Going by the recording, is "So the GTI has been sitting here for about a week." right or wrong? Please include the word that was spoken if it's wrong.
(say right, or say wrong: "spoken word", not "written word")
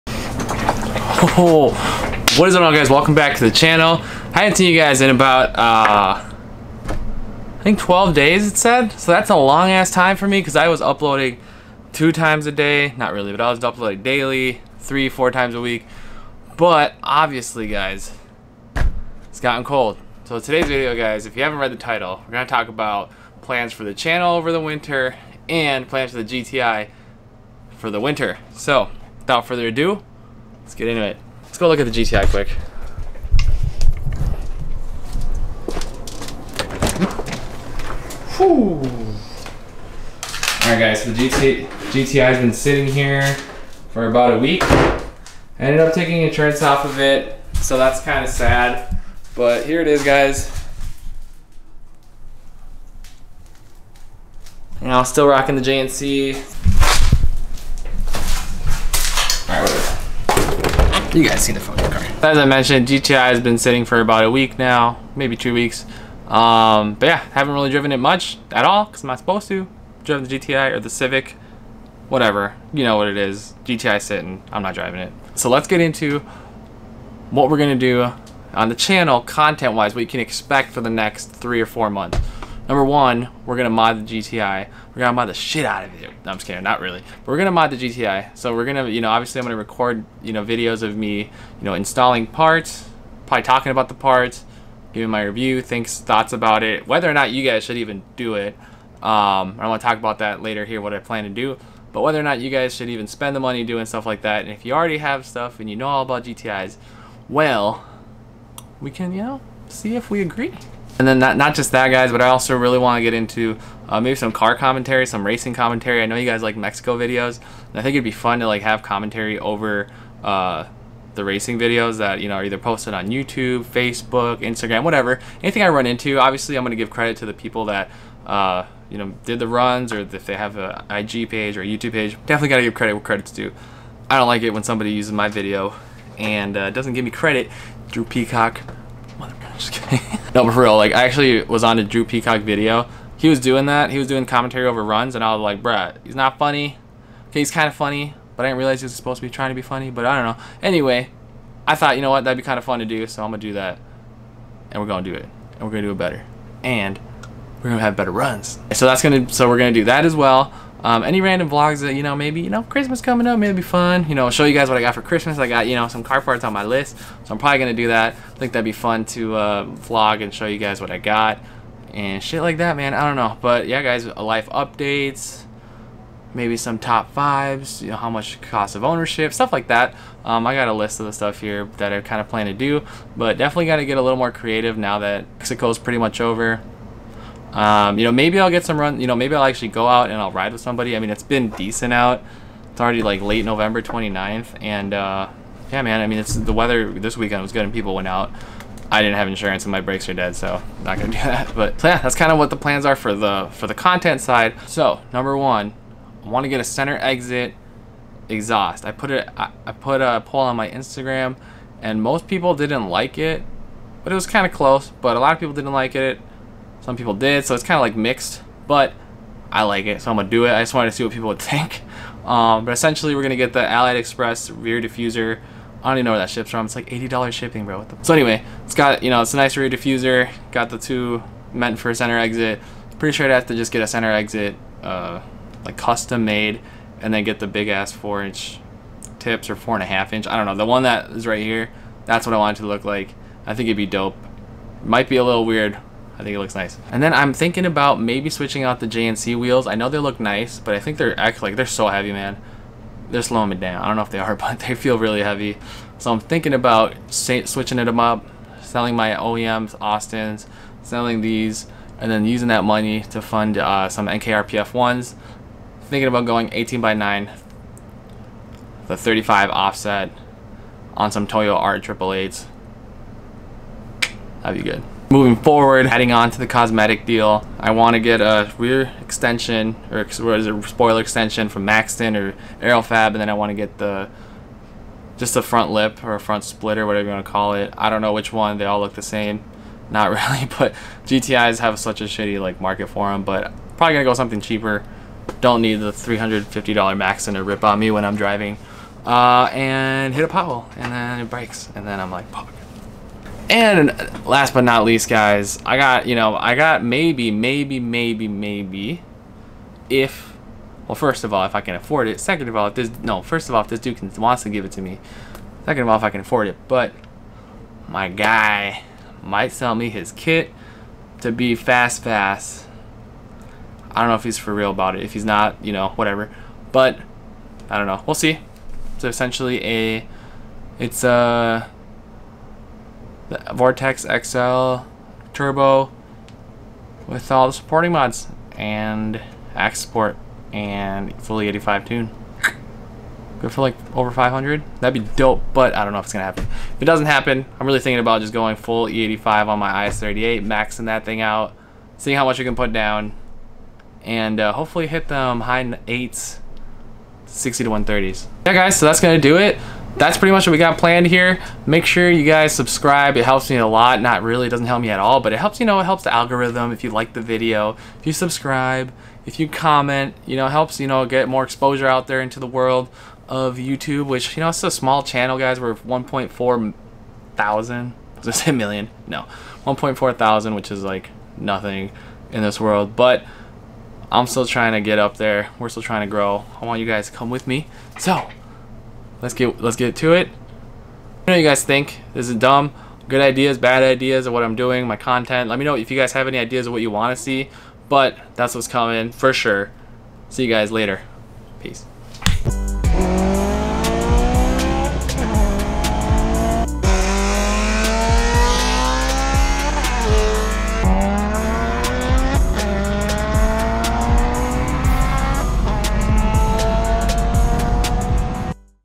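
right.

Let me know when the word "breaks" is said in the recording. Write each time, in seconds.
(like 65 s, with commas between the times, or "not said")
301 s.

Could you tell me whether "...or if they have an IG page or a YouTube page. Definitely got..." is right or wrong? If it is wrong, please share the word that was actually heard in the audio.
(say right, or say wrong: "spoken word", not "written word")
right.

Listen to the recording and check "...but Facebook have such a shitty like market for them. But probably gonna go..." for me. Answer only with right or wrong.
wrong.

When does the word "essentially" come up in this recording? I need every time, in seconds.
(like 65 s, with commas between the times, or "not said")
222 s, 329 s.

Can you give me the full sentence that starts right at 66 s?
Um, but yeah, haven't really driven it much at all because I'm not supposed to.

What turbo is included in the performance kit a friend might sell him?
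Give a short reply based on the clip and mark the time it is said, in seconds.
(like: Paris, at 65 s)
Vortex XL, at 333 s.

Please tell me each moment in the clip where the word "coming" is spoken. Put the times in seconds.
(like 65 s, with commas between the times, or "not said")
163 s, 398 s.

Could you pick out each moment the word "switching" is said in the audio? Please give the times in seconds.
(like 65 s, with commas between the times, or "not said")
248 s, 257 s.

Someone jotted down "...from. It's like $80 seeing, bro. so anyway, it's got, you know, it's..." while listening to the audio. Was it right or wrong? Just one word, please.
wrong.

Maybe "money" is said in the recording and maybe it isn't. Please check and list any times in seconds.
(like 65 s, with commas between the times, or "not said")
103 s, 262 s.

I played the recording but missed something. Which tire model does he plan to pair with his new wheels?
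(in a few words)
Toyo R888.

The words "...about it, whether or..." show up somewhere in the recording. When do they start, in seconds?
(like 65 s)
96 s.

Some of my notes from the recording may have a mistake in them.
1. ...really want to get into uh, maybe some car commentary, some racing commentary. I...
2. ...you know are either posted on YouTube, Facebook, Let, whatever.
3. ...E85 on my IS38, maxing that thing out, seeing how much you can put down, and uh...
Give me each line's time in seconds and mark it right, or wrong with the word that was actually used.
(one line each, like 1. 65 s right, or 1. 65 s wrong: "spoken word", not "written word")
1. 112 s right
2. 122 s wrong: "Instagram", not "Let"
3. 348 s right.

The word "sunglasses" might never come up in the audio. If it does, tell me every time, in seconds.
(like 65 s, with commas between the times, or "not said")
not said.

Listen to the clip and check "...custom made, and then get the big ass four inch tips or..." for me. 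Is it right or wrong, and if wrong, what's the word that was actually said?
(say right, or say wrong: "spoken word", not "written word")
right.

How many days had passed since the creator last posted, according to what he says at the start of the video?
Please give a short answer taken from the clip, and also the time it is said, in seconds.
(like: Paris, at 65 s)
12, at 7 s.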